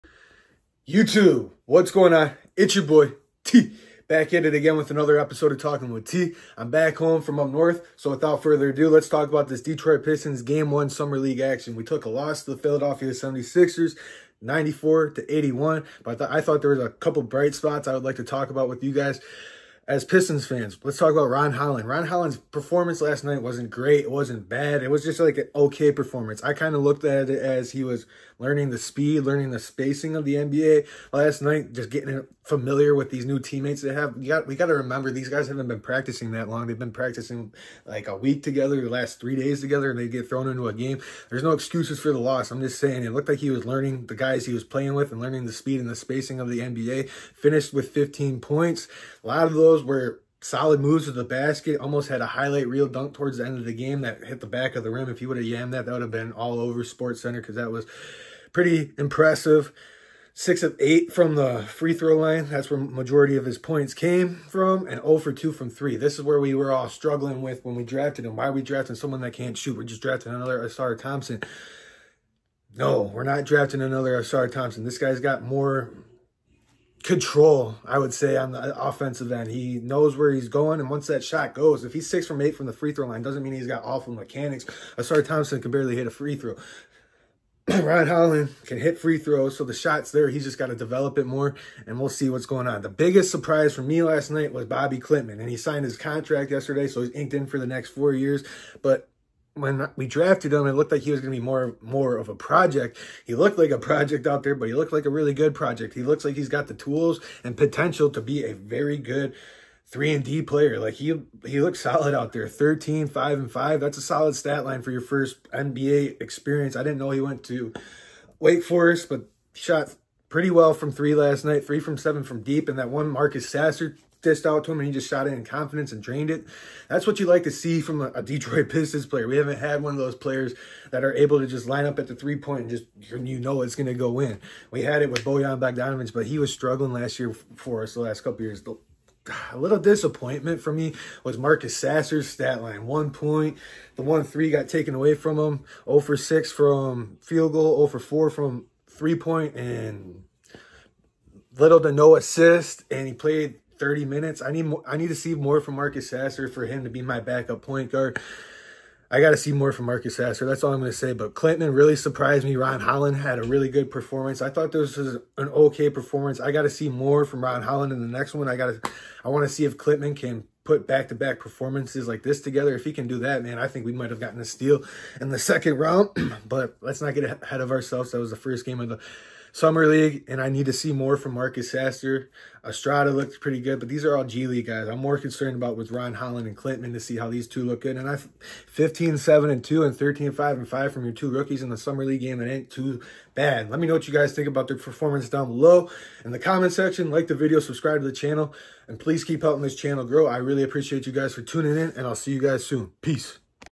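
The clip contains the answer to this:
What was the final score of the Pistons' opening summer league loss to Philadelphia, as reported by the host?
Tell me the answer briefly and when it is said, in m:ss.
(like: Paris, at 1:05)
94 to 81, at 0:14.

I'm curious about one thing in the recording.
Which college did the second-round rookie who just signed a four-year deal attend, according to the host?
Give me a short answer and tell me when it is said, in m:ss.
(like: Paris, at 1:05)
Wake Forest, at 1:58.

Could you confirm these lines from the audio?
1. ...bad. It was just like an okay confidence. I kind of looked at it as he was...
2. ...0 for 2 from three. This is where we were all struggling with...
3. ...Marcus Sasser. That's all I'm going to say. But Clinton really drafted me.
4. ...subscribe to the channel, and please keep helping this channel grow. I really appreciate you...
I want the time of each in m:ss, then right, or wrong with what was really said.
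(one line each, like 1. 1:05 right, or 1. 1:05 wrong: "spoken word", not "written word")
1. 0:24 wrong: "performance", not "confidence"
2. 1:05 right
3. 2:39 wrong: "surprised", not "drafted"
4. 3:17 right.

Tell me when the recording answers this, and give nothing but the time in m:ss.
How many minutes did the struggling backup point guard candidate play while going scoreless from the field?
2:33.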